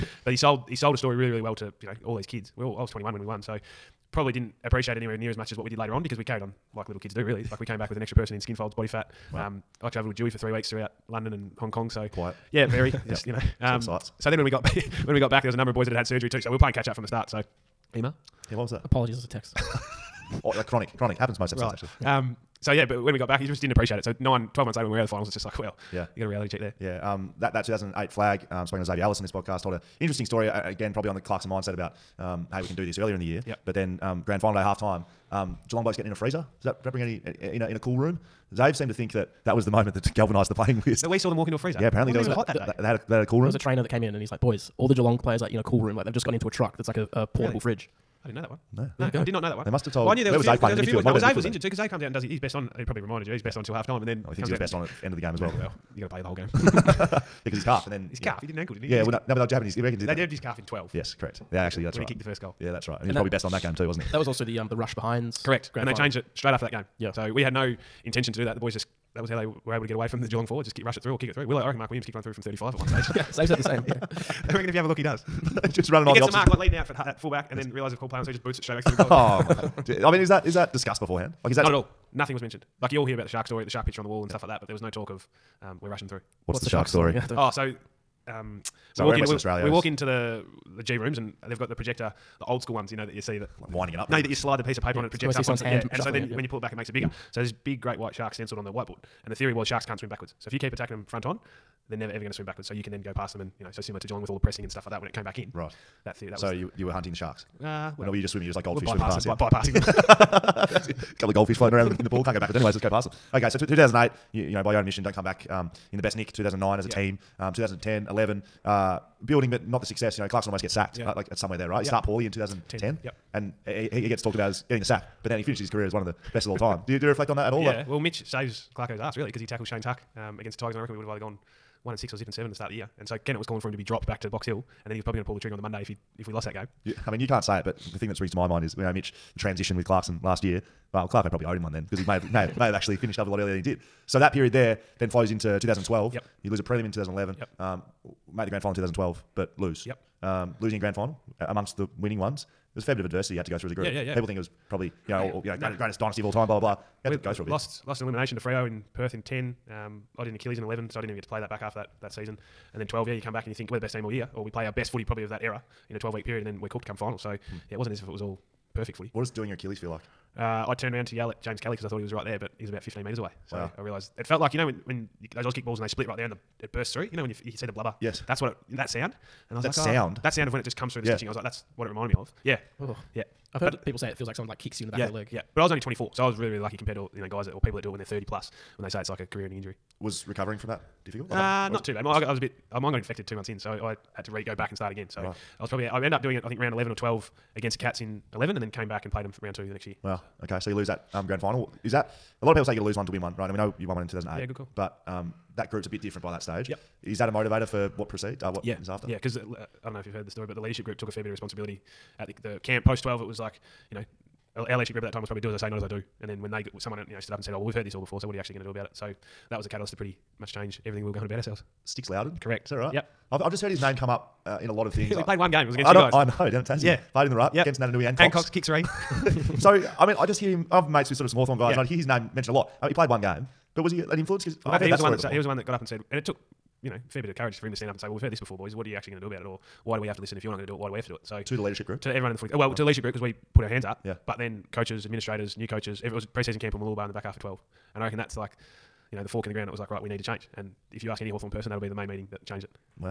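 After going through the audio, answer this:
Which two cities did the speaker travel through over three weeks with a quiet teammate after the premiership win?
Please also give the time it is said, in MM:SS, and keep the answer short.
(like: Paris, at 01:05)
London and Hong Kong, at 00:11.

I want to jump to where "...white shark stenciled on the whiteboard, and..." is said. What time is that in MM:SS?
01:37.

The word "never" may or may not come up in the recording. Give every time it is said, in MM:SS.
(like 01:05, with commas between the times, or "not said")
01:41.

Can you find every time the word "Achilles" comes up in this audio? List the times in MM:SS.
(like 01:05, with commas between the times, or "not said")
02:40, 02:49.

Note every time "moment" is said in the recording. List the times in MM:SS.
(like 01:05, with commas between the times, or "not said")
00:39.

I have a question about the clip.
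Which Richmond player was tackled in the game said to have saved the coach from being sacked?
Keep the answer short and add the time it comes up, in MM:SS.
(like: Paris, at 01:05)
Shane Tuck, at 02:09.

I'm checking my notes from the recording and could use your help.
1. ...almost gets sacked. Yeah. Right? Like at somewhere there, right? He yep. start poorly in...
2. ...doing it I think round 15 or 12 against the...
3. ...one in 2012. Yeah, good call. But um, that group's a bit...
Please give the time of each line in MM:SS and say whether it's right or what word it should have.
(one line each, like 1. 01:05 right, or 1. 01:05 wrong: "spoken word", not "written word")
1. 02:00 right
2. 03:16 wrong: "11", not "15"
3. 03:23 wrong: "2008", not "2012".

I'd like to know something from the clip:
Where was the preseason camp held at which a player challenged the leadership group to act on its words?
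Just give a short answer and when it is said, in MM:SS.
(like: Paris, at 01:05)
Mooloolaba, at 04:06.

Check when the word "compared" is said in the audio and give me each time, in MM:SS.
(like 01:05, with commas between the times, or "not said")
03:06.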